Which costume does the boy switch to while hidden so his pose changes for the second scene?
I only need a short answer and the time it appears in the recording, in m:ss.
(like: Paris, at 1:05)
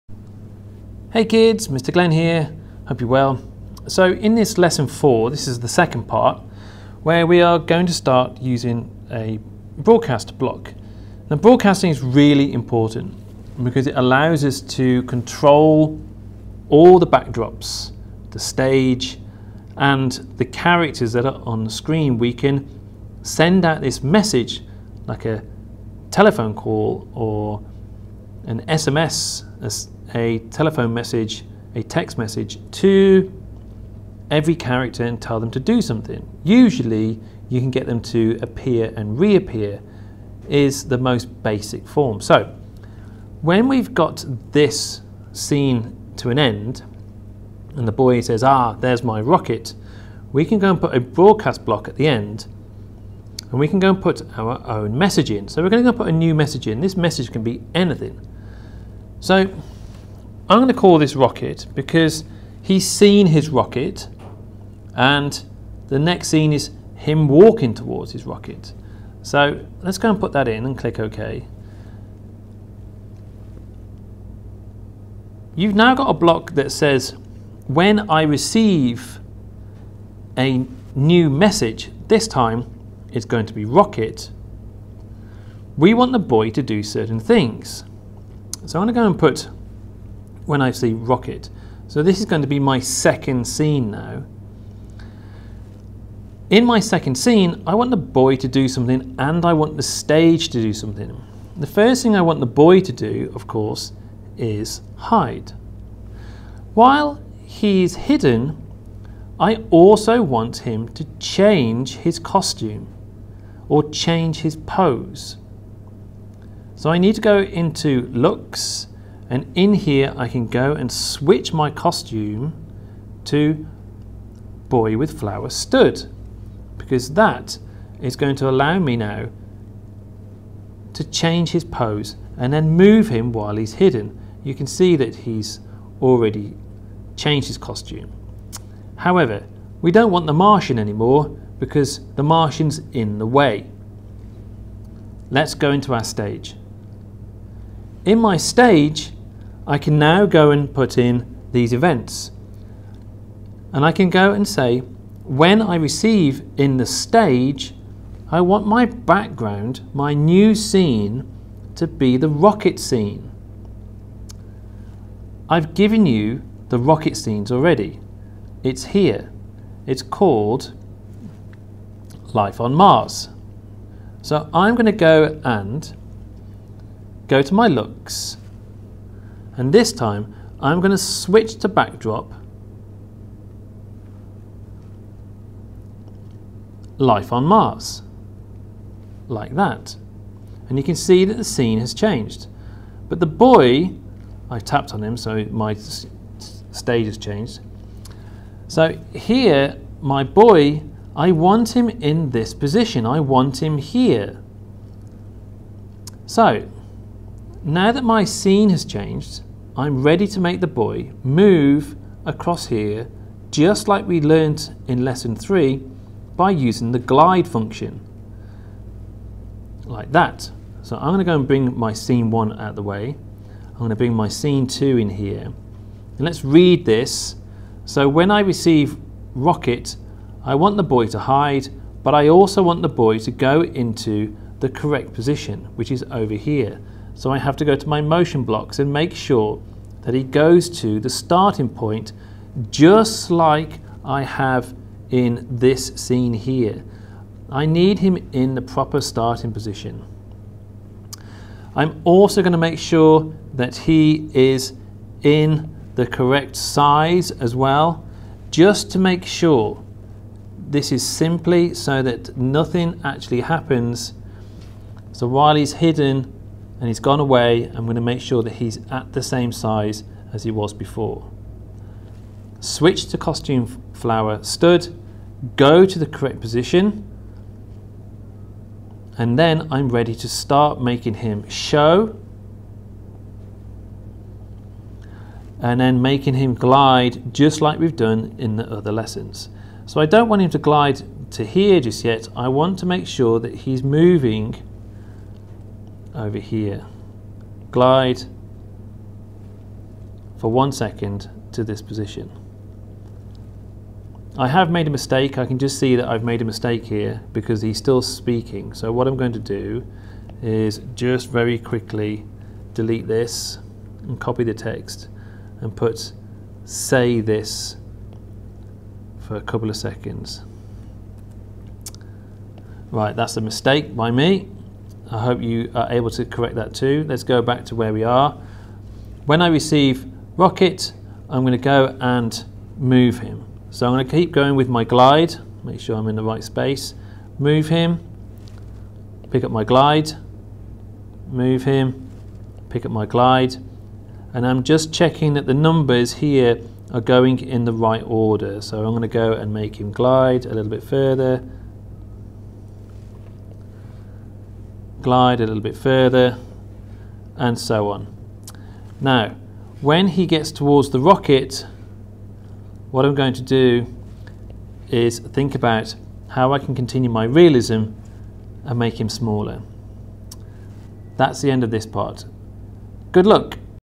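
Boy with Flower Stood, at 2:04.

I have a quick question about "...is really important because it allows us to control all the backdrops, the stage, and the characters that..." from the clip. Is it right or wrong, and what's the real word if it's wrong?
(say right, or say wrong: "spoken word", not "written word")
right.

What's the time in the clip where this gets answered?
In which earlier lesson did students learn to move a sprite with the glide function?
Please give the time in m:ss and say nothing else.
3:35.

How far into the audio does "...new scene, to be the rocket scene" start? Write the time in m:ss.
2:40.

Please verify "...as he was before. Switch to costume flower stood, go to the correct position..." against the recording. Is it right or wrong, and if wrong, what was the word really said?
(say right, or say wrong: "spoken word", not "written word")
right.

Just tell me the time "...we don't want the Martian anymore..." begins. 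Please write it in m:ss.
2:19.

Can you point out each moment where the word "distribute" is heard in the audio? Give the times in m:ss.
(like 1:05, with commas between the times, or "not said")
not said.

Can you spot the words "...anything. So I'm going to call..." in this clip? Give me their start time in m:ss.
0:57.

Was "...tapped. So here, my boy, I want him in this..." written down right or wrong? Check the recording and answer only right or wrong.
wrong.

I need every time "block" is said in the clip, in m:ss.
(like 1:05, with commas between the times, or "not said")
0:10, 0:51, 1:16, 3:58.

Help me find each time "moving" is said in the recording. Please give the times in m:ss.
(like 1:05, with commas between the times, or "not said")
4:53.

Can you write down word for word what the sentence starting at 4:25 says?
So while he's hidden, and he's gone away.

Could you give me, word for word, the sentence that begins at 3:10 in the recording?
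And you can see that the scene has changed.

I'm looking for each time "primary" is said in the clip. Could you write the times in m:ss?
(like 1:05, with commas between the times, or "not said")
not said.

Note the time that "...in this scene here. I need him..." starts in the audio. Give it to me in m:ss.
4:05.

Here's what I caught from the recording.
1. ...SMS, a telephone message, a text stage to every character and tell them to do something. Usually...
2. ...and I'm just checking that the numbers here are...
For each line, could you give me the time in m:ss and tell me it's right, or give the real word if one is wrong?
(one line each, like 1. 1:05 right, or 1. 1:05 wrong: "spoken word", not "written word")
1. 0:28 wrong: "message", not "stage"
2. 5:44 right.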